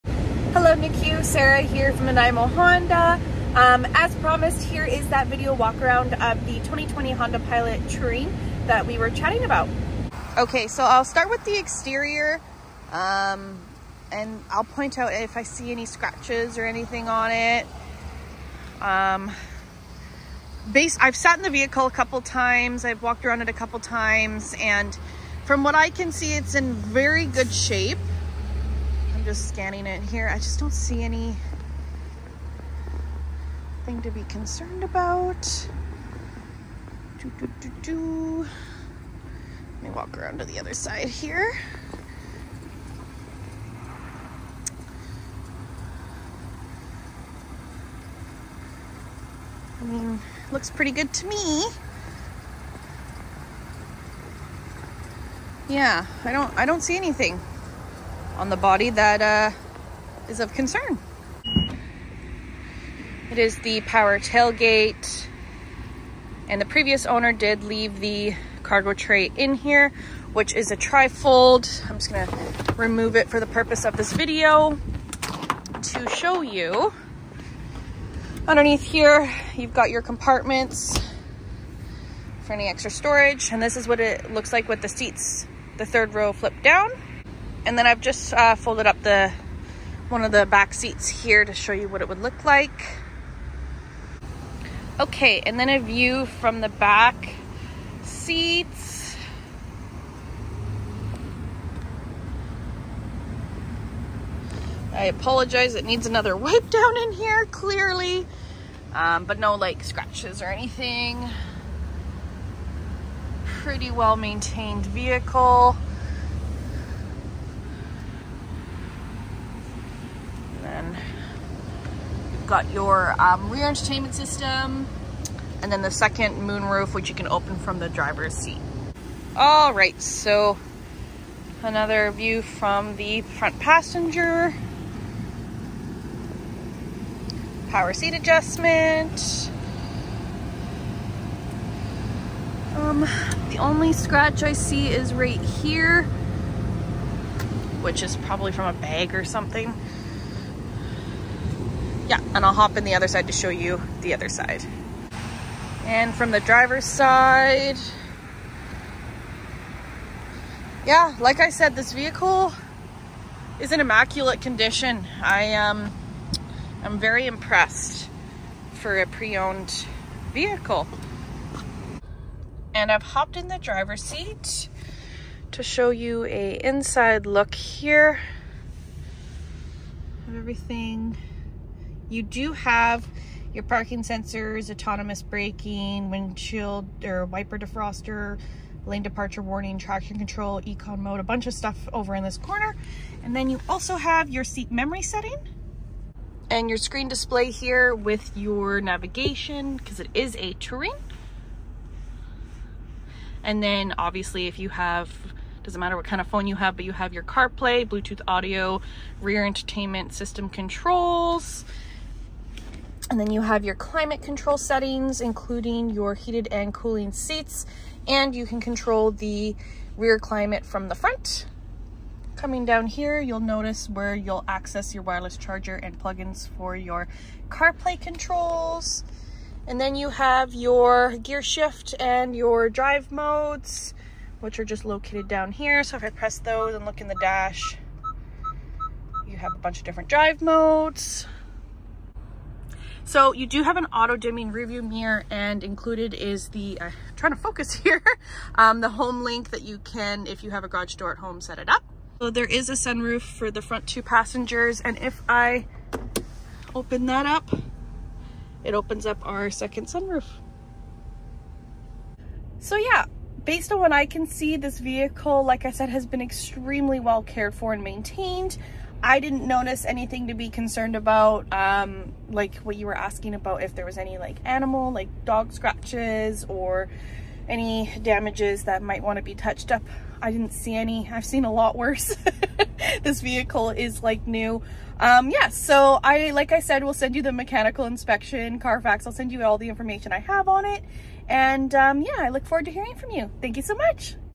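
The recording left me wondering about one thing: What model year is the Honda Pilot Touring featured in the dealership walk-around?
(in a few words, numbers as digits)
2020.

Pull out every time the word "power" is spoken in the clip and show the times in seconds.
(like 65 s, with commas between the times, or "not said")
63 s, 137 s.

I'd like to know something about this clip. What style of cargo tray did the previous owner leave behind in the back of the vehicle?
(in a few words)
trifold.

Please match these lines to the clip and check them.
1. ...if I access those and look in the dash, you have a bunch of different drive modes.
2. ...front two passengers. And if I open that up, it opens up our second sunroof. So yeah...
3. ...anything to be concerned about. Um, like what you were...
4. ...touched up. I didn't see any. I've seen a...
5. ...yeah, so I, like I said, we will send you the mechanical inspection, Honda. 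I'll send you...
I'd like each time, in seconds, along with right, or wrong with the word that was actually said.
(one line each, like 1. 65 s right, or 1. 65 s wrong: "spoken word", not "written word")
1. 235 s wrong: "press", not "access"
2. 253 s right
3. 269 s right
4. 279 s right
5. 285 s wrong: "Carfax", not "Honda".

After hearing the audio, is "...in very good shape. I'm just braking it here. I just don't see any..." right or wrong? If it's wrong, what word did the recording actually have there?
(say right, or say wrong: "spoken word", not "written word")
wrong: "scanning", not "braking".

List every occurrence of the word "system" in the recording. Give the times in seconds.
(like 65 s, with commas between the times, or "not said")
124 s, 210 s.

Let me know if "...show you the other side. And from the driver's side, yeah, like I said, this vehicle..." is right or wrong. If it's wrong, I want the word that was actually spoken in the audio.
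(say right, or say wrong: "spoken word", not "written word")
right.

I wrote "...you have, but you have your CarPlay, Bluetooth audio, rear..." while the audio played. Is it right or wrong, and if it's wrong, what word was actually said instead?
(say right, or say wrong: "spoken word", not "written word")
right.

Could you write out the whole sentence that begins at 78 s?
Underneath here, you've got your compartments for any extra storage.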